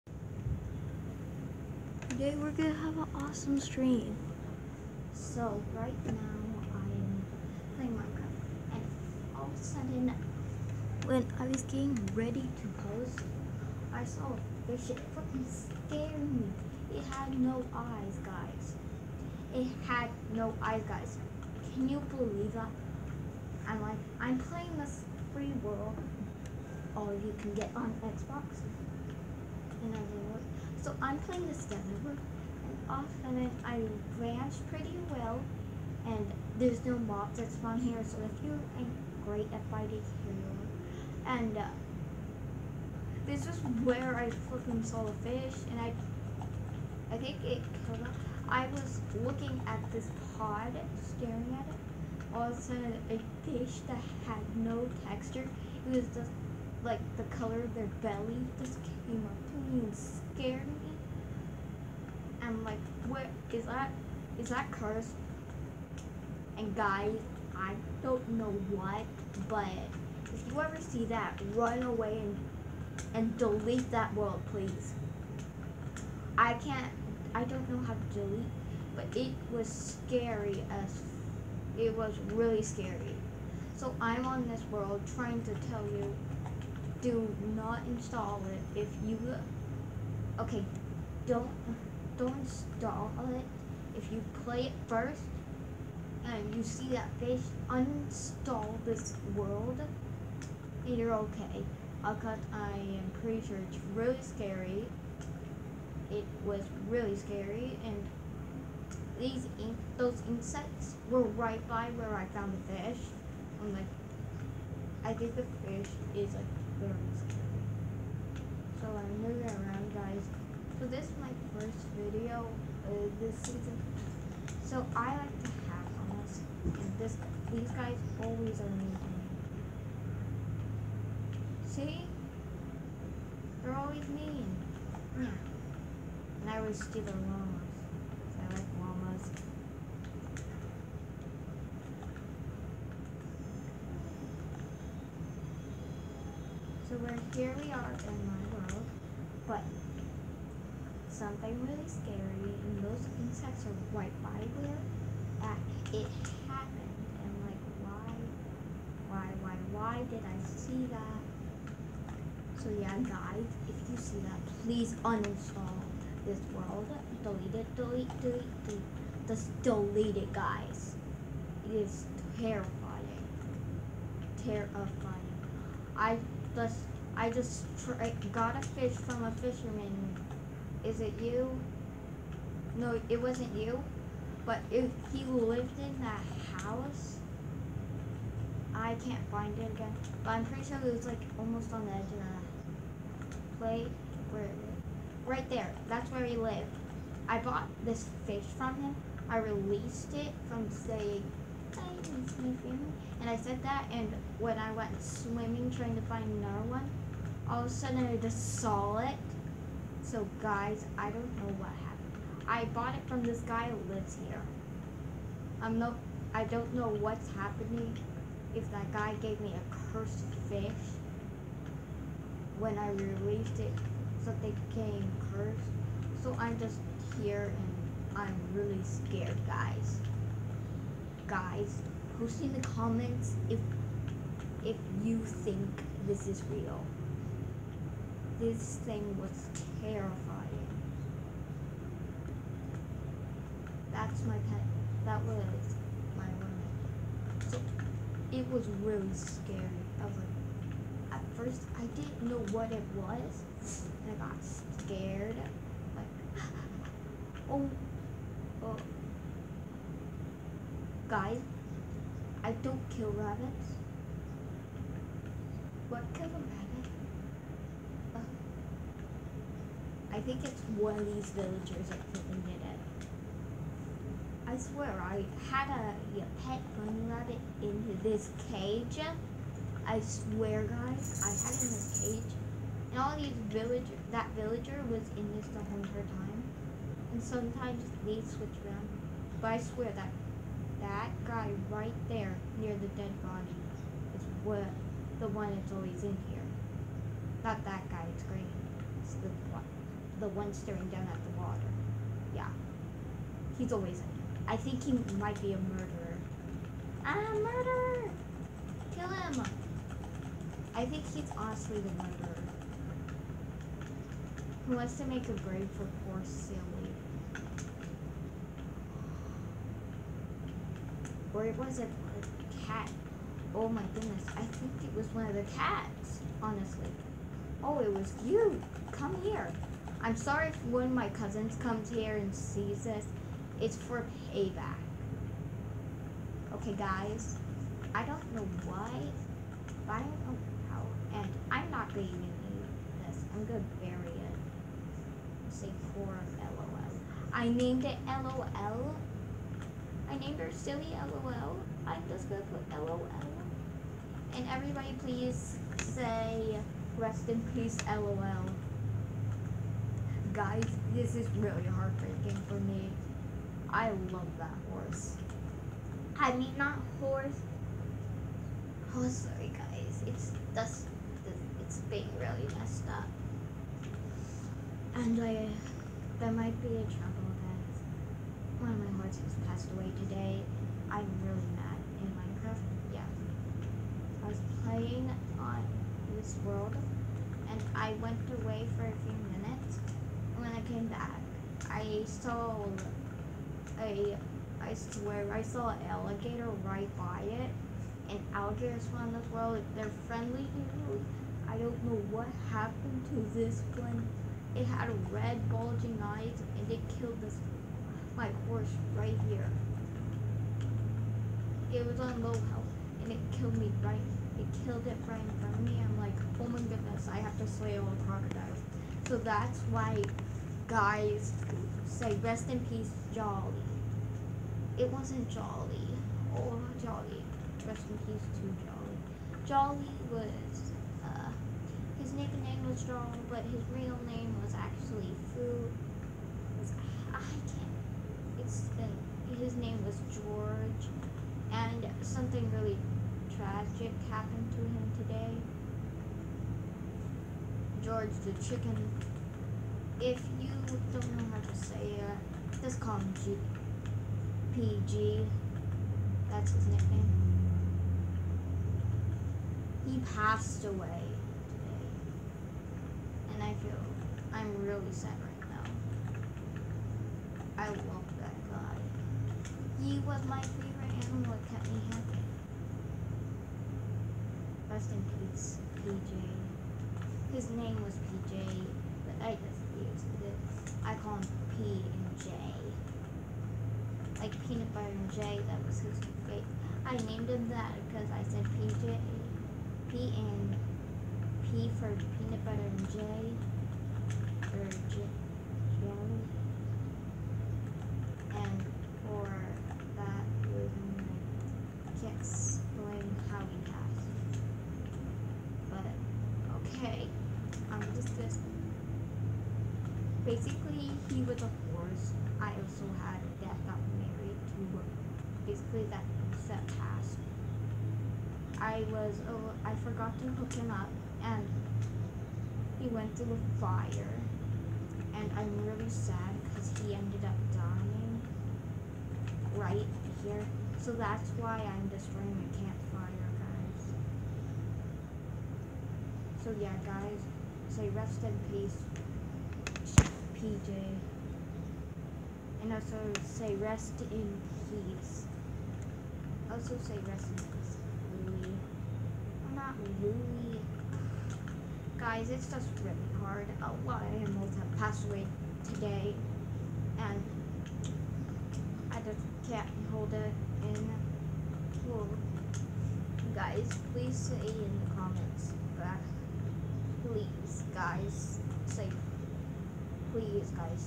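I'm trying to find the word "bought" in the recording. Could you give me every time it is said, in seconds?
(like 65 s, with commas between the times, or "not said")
197 s, 212 s.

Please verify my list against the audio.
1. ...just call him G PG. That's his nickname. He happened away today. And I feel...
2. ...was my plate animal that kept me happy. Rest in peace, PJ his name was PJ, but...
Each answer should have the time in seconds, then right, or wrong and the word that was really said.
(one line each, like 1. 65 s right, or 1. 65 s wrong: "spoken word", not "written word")
1. 452 s wrong: "passed", not "happened"
2. 470 s wrong: "favorite", not "plate".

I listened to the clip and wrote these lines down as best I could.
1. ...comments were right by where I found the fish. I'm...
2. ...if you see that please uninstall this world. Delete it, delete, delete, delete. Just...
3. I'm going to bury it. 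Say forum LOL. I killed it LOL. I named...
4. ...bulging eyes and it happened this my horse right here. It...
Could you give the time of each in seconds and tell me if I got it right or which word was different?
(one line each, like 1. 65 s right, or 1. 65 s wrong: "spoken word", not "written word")
1. 110 s wrong: "insects", not "comments"
2. 163 s right
3. 343 s wrong: "named", not "killed"
4. 405 s wrong: "killed", not "happened".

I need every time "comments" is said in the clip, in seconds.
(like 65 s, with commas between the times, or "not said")
232 s, 564 s.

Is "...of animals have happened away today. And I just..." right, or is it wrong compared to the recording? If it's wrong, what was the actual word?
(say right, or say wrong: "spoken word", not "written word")
wrong: "passed", not "happened".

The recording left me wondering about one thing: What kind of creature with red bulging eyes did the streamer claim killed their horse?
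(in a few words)
Alligator.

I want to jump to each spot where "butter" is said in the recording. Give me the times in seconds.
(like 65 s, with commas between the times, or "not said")
484 s, 492 s.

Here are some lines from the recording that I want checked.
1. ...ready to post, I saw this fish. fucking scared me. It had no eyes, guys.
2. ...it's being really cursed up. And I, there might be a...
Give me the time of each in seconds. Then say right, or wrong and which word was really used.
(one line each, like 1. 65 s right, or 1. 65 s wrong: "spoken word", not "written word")
1. 12 s right
2. 371 s wrong: "messed", not "cursed".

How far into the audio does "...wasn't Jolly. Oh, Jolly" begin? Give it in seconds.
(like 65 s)
424 s.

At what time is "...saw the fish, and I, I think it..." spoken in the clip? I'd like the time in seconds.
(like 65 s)
44 s.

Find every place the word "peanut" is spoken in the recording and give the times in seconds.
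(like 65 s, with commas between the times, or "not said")
484 s, 492 s.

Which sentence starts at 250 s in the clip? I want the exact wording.
I was like, at first I didn't know what it was, and I got scared.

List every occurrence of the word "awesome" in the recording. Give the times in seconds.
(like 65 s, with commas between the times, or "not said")
3 s.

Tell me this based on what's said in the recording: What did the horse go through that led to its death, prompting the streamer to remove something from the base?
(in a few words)
A fire.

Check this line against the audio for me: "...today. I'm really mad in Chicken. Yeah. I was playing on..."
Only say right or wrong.
wrong.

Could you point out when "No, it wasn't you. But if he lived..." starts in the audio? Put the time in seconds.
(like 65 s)
182 s.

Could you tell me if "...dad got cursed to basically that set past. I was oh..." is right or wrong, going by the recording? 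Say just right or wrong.
wrong.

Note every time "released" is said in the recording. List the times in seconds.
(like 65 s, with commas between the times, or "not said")
199 s, 222 s.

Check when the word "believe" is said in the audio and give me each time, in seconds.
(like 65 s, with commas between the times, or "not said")
22 s.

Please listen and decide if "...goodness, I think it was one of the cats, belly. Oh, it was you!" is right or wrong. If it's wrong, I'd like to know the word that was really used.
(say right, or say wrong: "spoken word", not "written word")
wrong: "honestly", not "belly".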